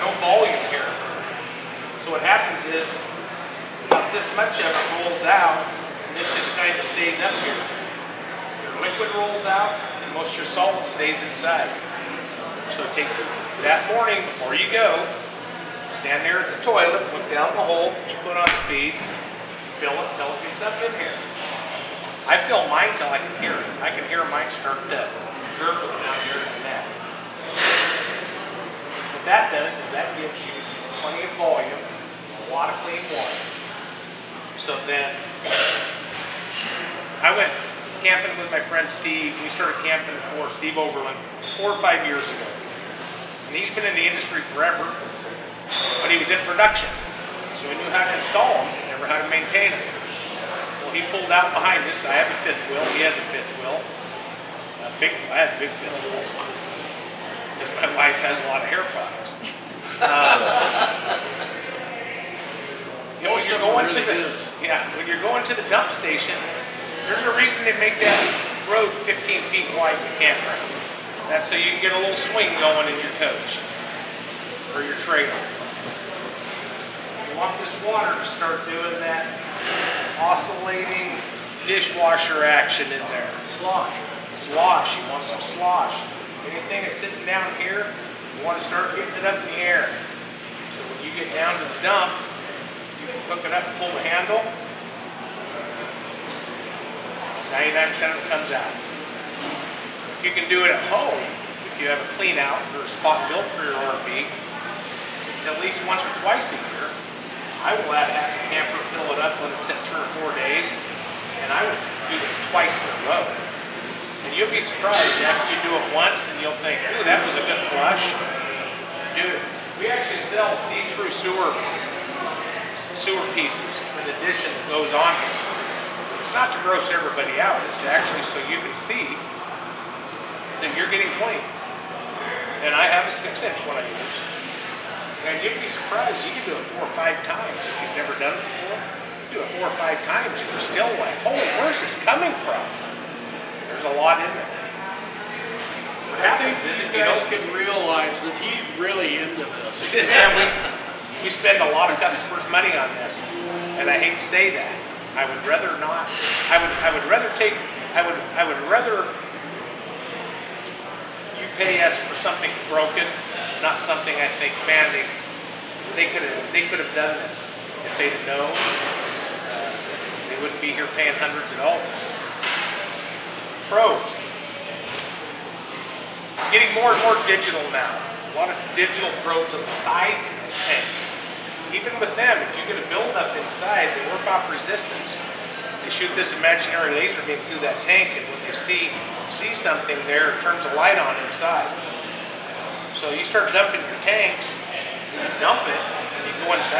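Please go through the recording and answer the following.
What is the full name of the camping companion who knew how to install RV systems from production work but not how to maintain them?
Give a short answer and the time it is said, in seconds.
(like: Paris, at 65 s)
Steve Oberlin, at 40 s.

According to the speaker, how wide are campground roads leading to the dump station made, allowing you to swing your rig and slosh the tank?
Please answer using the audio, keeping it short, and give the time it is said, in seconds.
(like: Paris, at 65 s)
15 feet, at 69 s.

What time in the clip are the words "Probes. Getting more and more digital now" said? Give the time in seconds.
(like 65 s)
173 s.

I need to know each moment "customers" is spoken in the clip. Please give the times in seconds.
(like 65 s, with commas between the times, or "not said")
151 s.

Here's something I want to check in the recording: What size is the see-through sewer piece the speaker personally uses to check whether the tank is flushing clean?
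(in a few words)
6 inch.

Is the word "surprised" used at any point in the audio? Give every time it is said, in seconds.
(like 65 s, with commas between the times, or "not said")
114 s, 135 s.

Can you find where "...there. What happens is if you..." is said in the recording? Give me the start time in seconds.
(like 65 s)
144 s.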